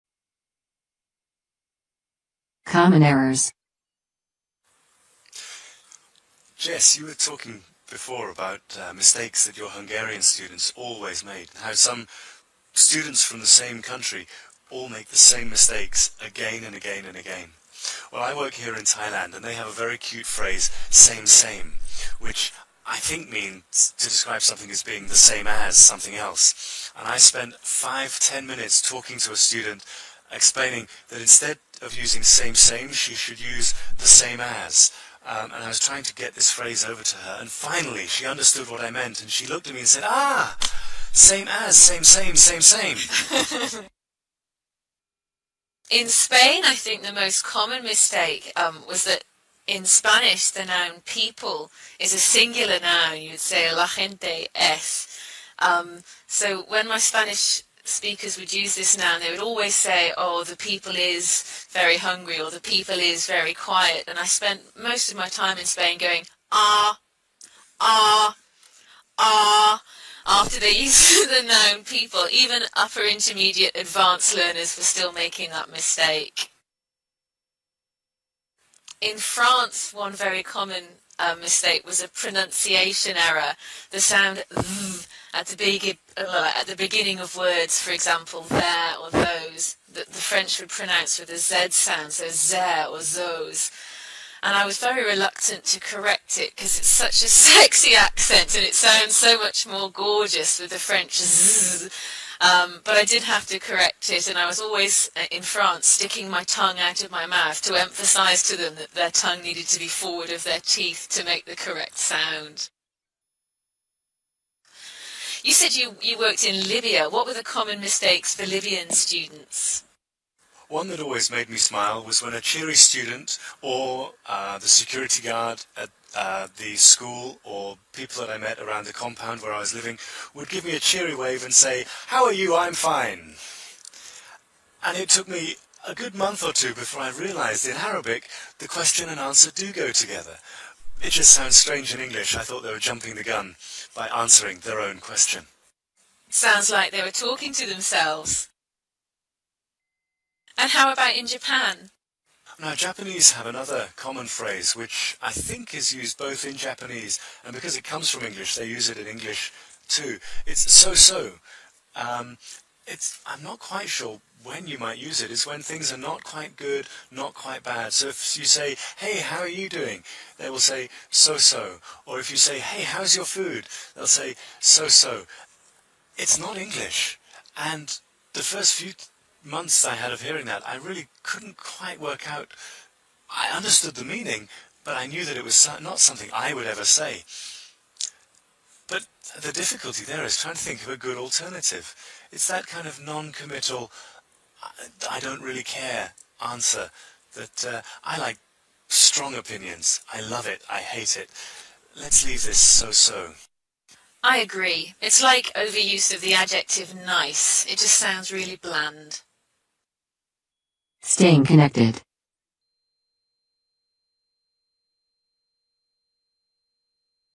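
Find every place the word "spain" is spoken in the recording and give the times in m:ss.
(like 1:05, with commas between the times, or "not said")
0:46, 1:05.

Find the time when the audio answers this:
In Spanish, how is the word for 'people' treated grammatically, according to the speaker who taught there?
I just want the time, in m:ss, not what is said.
0:52.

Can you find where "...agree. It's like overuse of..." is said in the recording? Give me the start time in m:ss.
3:24.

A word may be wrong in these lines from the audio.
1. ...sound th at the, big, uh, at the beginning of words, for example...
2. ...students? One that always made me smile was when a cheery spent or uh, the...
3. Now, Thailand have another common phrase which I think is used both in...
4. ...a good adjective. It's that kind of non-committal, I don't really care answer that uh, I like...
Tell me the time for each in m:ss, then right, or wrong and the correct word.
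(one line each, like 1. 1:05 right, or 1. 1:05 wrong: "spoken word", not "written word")
1. 1:23 right
2. 1:58 wrong: "student", not "spent"
3. 2:32 wrong: "Japanese", not "Thailand"
4. 3:10 wrong: "alternative", not "adjective".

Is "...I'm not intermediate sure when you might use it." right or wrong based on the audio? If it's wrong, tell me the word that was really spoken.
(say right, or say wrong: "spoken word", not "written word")
wrong: "quite", not "intermediate".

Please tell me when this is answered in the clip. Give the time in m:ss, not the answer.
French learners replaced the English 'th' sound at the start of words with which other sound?
1:31.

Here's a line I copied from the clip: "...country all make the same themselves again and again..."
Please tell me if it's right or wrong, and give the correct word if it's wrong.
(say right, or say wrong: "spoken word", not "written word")
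wrong: "mistakes", not "themselves".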